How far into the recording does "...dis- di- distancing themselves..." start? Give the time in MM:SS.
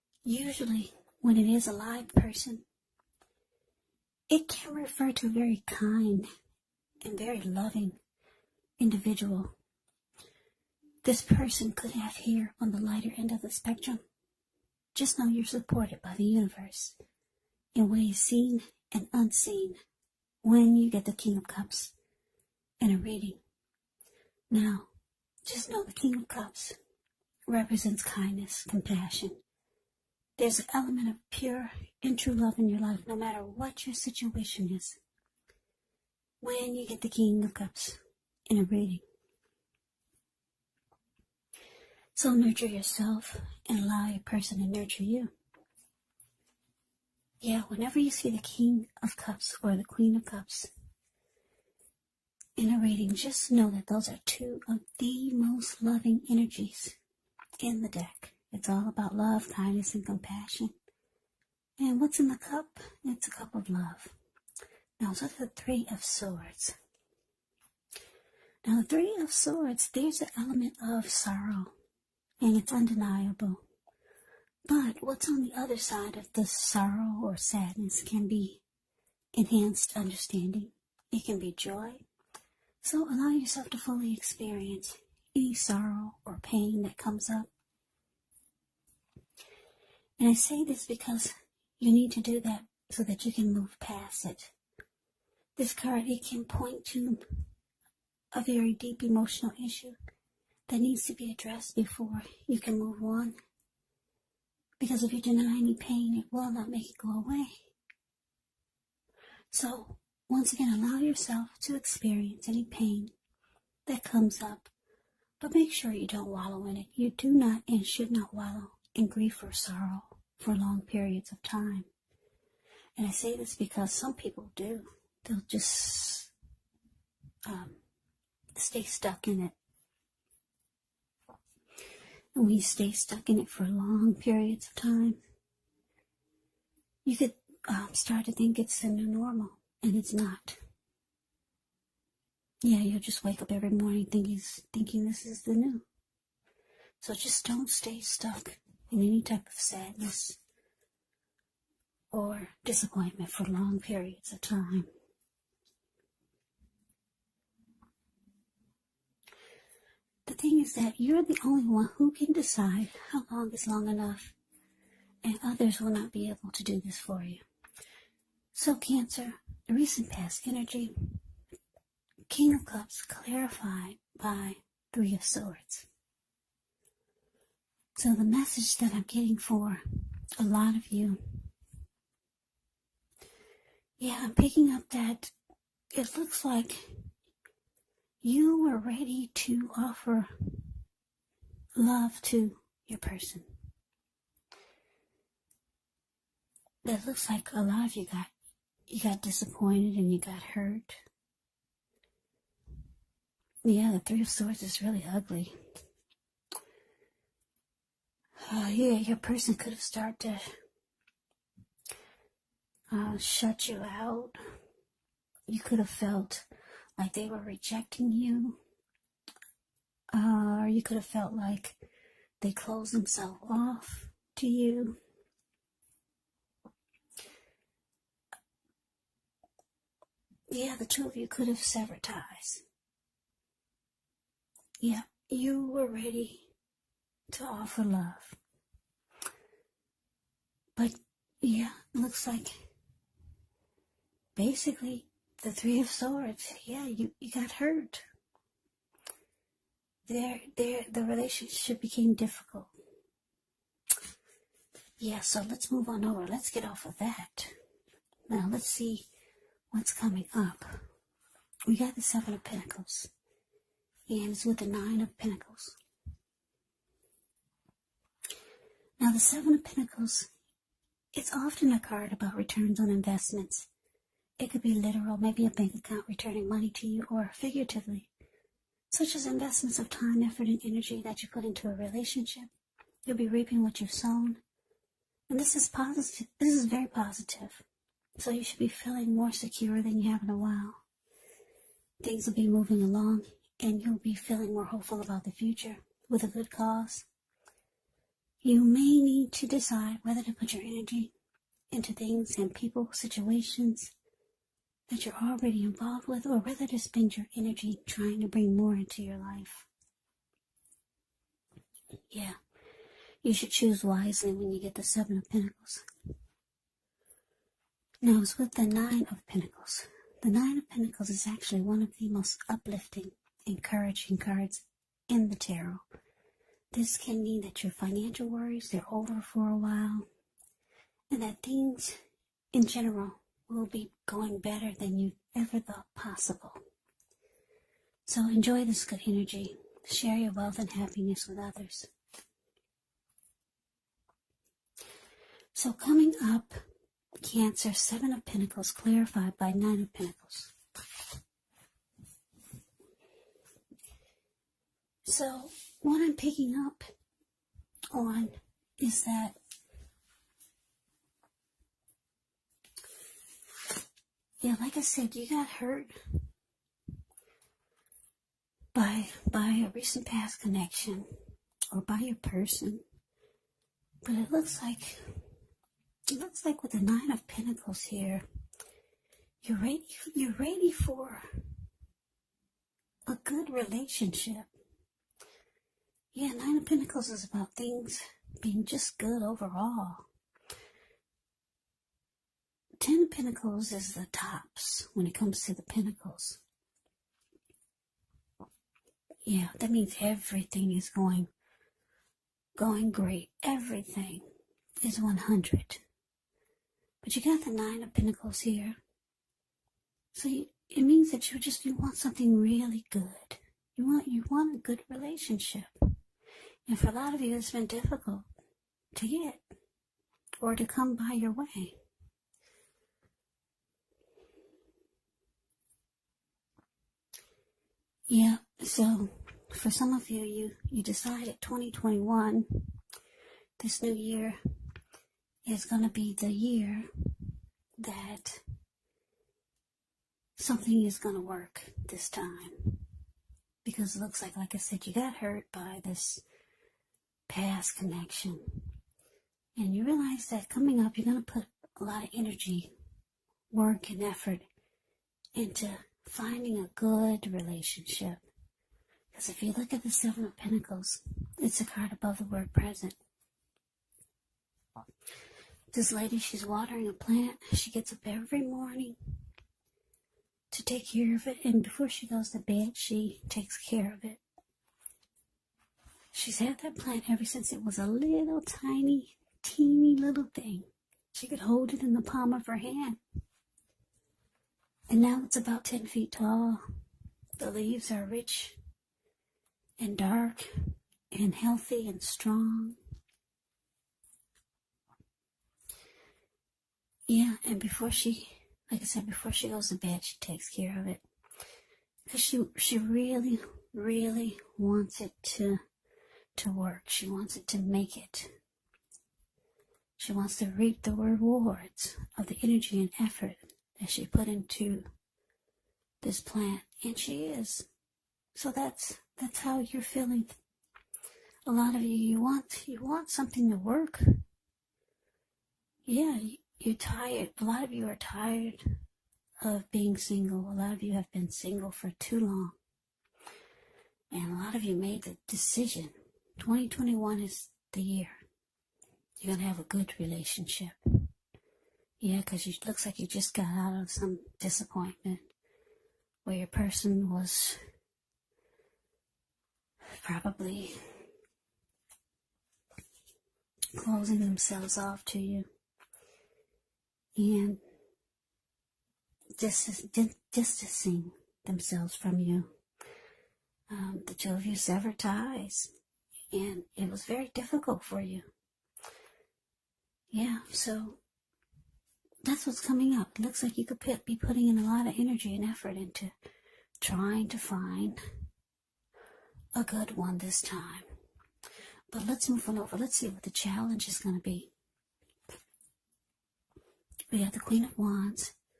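09:19.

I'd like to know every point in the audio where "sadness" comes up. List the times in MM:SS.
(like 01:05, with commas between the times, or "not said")
01:17, 02:29.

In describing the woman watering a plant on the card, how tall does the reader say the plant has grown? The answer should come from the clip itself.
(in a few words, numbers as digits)
10 feet.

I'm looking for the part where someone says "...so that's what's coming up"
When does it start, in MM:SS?
09:30.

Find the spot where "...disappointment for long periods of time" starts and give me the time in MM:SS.
02:32.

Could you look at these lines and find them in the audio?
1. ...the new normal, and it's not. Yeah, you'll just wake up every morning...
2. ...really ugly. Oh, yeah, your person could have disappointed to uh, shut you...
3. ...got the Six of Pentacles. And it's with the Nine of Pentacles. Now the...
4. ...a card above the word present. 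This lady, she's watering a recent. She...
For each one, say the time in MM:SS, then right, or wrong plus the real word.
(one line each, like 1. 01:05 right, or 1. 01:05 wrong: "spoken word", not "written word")
1. 02:18 right
2. 03:24 wrong: "started", not "disappointed"
3. 04:21 wrong: "Seven", not "Six"
4. 07:41 wrong: "plant", not "recent".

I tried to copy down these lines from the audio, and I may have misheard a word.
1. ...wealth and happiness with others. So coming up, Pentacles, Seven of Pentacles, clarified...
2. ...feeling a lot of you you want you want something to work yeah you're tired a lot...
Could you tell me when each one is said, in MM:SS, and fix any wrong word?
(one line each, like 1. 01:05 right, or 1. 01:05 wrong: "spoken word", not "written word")
1. 05:40 wrong: "Cancer", not "Pentacles"
2. 08:39 right.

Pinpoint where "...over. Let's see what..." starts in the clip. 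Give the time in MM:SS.
09:42.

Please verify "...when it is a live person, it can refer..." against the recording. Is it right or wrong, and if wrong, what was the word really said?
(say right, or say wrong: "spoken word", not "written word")
right.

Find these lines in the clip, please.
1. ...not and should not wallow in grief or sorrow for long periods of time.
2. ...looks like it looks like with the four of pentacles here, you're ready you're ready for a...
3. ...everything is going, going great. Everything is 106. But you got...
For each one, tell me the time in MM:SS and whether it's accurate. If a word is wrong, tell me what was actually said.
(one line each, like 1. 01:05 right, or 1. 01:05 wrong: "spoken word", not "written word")
1. 01:57 right
2. 06:14 wrong: "nine", not "four"
3. 06:40 wrong: "100", not "106".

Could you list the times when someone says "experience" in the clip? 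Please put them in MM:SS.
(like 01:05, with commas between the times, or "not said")
01:24, 01:51.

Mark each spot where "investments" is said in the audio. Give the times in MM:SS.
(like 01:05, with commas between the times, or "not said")
04:32, 04:39.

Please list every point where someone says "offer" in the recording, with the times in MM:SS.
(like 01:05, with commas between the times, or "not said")
03:09, 03:57.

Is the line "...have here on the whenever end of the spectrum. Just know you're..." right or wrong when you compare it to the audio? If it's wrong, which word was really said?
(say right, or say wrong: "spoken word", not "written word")
wrong: "lighter", not "whenever".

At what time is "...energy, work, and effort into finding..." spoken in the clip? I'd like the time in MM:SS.
07:32.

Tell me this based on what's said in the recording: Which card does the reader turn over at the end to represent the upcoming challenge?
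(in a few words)
Queen of Wands.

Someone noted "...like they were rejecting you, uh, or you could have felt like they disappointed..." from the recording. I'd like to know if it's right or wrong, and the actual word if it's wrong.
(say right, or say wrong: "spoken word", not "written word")
wrong: "closed", not "disappointed".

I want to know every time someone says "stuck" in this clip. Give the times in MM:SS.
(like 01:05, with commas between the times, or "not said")
02:08, 02:12, 02:28.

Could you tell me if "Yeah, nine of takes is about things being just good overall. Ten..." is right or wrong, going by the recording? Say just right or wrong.
wrong.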